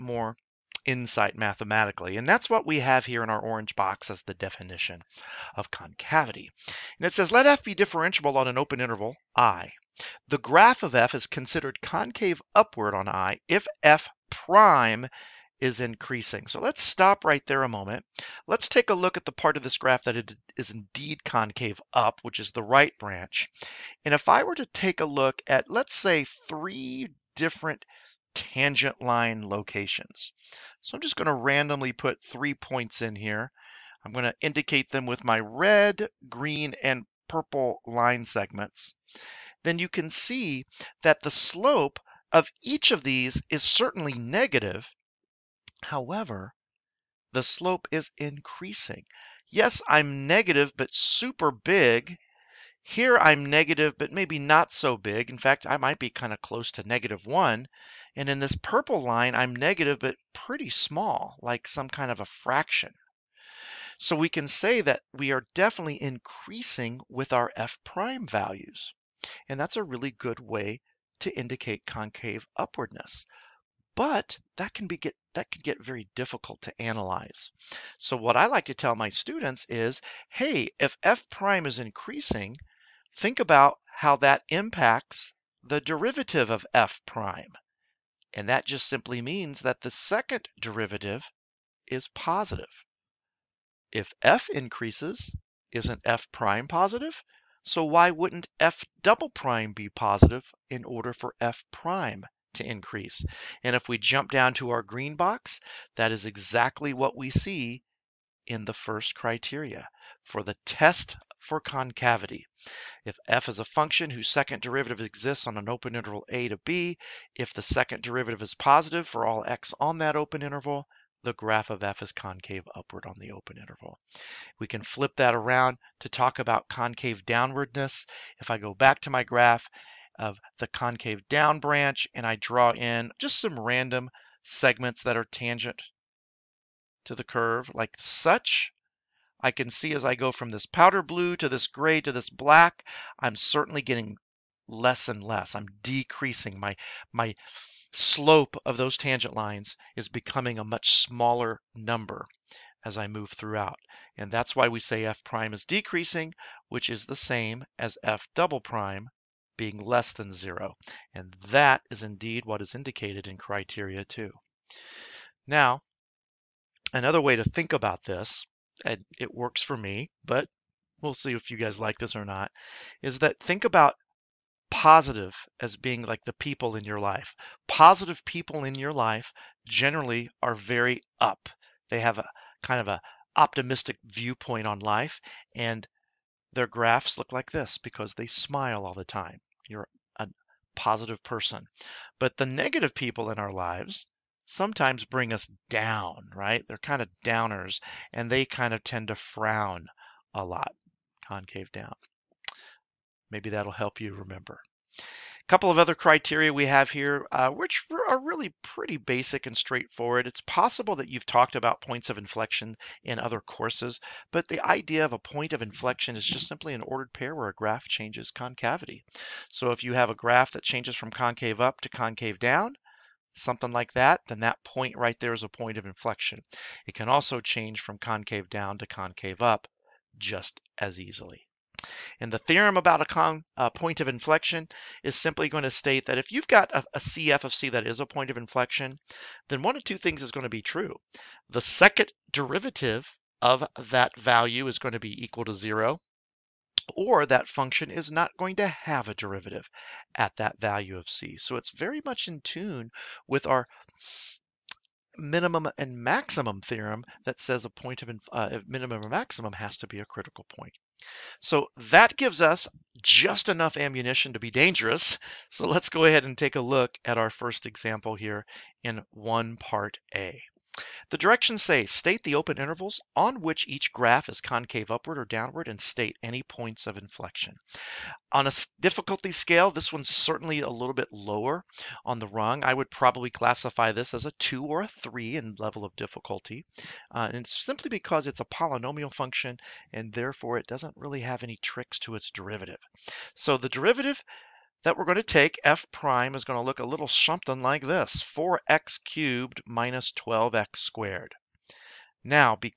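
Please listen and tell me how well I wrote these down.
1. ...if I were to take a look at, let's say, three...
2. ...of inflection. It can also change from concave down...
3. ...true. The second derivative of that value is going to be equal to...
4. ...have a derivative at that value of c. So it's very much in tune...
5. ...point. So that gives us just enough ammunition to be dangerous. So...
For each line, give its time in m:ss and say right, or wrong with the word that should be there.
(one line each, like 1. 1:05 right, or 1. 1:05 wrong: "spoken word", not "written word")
1. 0:24 right
2. 3:45 right
3. 4:00 right
4. 4:08 right
5. 4:20 right.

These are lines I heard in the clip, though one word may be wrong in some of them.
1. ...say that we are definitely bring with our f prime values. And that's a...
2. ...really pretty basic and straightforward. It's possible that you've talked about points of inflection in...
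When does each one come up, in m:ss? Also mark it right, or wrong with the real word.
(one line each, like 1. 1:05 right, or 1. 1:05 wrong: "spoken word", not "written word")
1. 1:04 wrong: "increasing", not "bring"
2. 3:28 right.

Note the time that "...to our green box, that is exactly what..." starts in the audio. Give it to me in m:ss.
1:44.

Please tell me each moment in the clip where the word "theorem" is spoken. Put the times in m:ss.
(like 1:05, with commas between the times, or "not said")
3:52, 4:16.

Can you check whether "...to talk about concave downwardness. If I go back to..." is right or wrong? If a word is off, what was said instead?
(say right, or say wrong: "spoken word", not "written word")
right.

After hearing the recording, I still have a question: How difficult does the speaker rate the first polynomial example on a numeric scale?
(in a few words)
2 or 3.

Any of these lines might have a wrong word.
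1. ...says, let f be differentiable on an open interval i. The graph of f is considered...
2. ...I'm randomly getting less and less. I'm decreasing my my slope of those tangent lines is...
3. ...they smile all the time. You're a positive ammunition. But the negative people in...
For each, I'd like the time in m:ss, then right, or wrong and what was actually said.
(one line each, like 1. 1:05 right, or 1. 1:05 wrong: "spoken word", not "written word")
1. 0:07 right
2. 2:23 wrong: "certainly", not "randomly"
3. 3:08 wrong: "person", not "ammunition".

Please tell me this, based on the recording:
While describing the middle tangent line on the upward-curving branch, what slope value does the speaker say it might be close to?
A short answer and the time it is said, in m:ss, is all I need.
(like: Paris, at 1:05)
-1, at 0:56.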